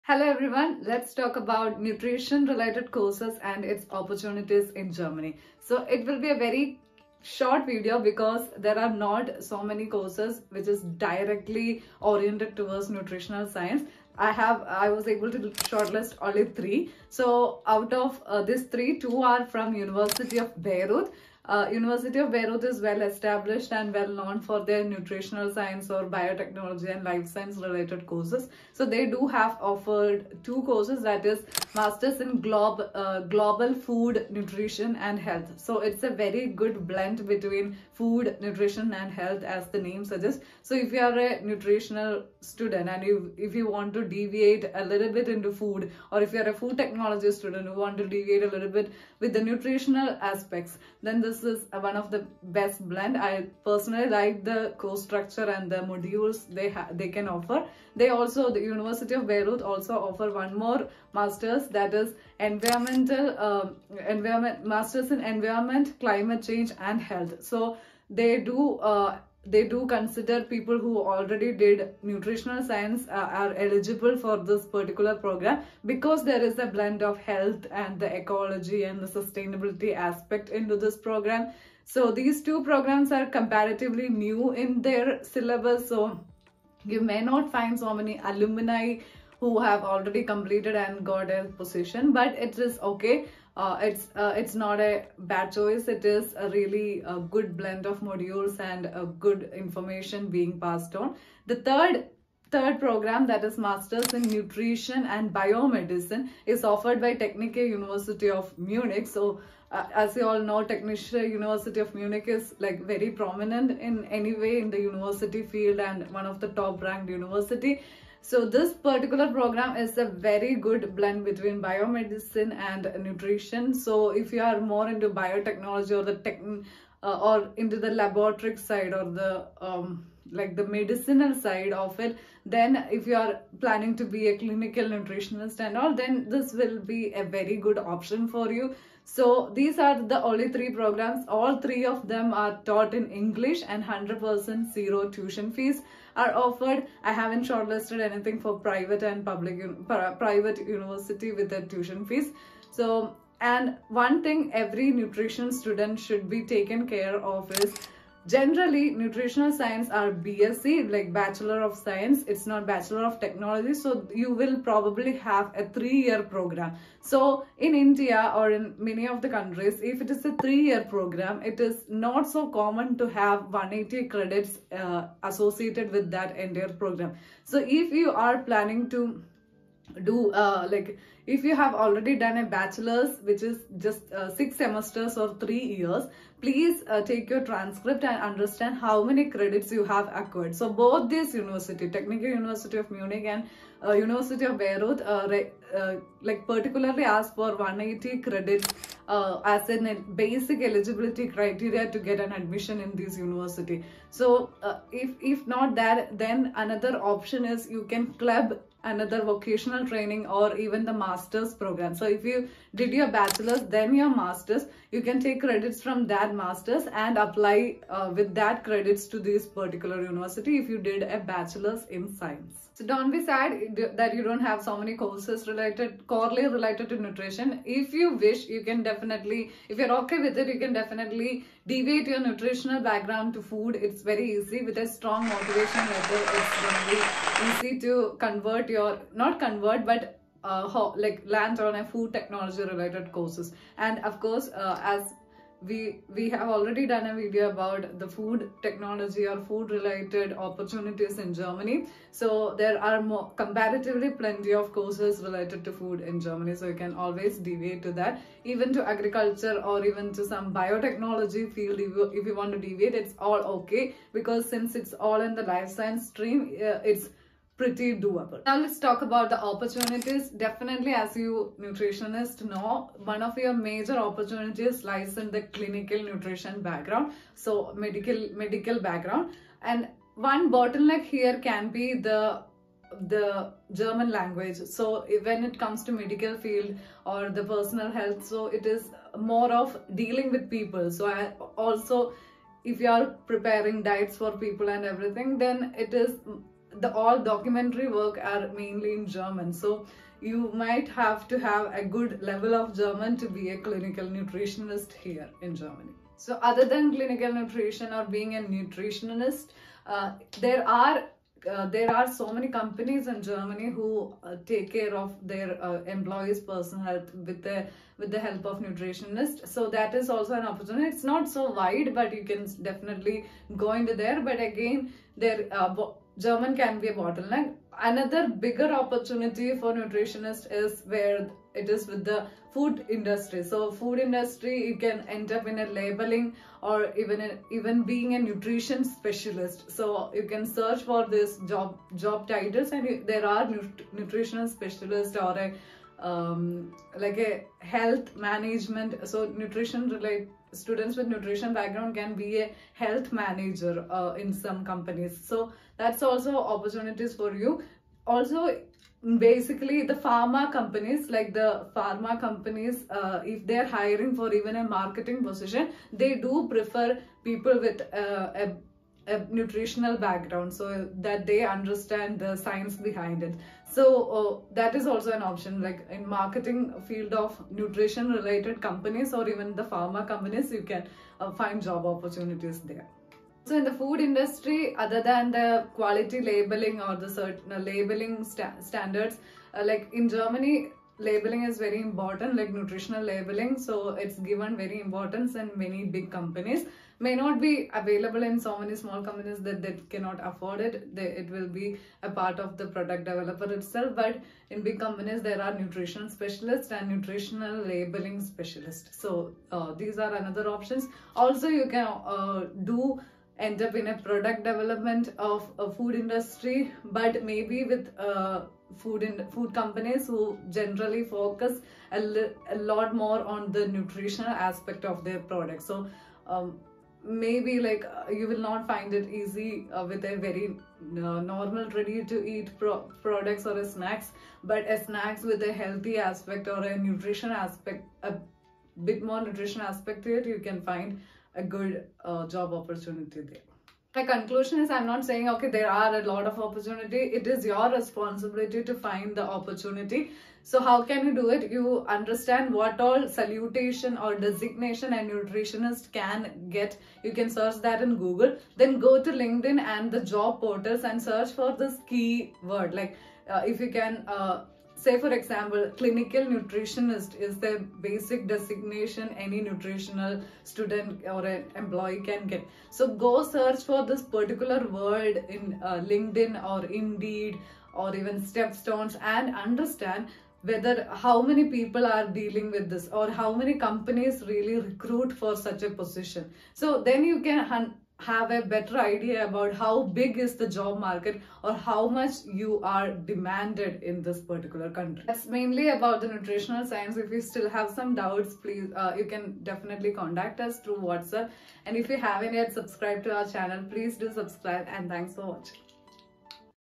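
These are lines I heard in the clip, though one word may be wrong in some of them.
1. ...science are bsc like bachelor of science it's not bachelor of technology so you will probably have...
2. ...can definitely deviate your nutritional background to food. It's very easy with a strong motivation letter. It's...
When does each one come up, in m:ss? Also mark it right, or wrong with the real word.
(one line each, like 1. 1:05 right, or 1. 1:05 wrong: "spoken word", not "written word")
1. 2:39 right
2. 3:50 right.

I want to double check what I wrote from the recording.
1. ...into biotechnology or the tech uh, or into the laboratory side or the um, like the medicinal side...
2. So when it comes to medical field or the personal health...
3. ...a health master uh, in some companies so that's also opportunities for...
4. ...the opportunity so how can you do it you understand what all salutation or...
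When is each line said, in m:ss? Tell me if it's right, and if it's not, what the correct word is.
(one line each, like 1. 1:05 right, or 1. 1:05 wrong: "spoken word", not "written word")
1. 2:04 right
2. 4:44 right
3. 5:52 wrong: "manager", not "master"
4. 7:29 right.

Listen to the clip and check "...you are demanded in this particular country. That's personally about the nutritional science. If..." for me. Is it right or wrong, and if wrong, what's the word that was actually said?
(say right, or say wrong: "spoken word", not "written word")
wrong: "mainly", not "personally".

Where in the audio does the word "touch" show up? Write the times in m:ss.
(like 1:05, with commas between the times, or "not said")
not said.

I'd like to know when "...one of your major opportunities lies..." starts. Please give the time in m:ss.
4:33.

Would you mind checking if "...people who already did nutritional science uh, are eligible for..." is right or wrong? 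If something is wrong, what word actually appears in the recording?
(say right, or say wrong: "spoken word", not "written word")
right.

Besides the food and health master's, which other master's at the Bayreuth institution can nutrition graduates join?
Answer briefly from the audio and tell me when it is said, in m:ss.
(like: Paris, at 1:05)
Environment, Climate Change and Health, at 1:05.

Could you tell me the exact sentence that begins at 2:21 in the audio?
All three of them are taught in English and 100% zero tuition fees are offered.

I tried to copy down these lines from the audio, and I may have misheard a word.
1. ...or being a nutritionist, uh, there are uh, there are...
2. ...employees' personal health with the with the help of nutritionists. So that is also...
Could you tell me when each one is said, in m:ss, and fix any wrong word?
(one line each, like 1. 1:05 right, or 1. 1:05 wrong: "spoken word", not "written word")
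1. 5:07 right
2. 5:15 right.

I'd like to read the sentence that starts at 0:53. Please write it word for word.
I personally like the course structure and the modules they they can offer.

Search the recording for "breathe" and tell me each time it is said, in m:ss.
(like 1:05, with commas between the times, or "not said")
not said.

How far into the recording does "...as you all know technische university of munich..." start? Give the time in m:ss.
1:49.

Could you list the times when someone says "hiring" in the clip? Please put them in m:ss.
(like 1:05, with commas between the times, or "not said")
6:03.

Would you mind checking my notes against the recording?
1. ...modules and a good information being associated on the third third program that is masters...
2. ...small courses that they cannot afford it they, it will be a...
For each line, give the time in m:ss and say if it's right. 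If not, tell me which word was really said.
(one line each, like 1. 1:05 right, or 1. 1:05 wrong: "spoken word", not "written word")
1. 1:38 wrong: "passed", not "associated"
2. 6:38 wrong: "companies", not "courses".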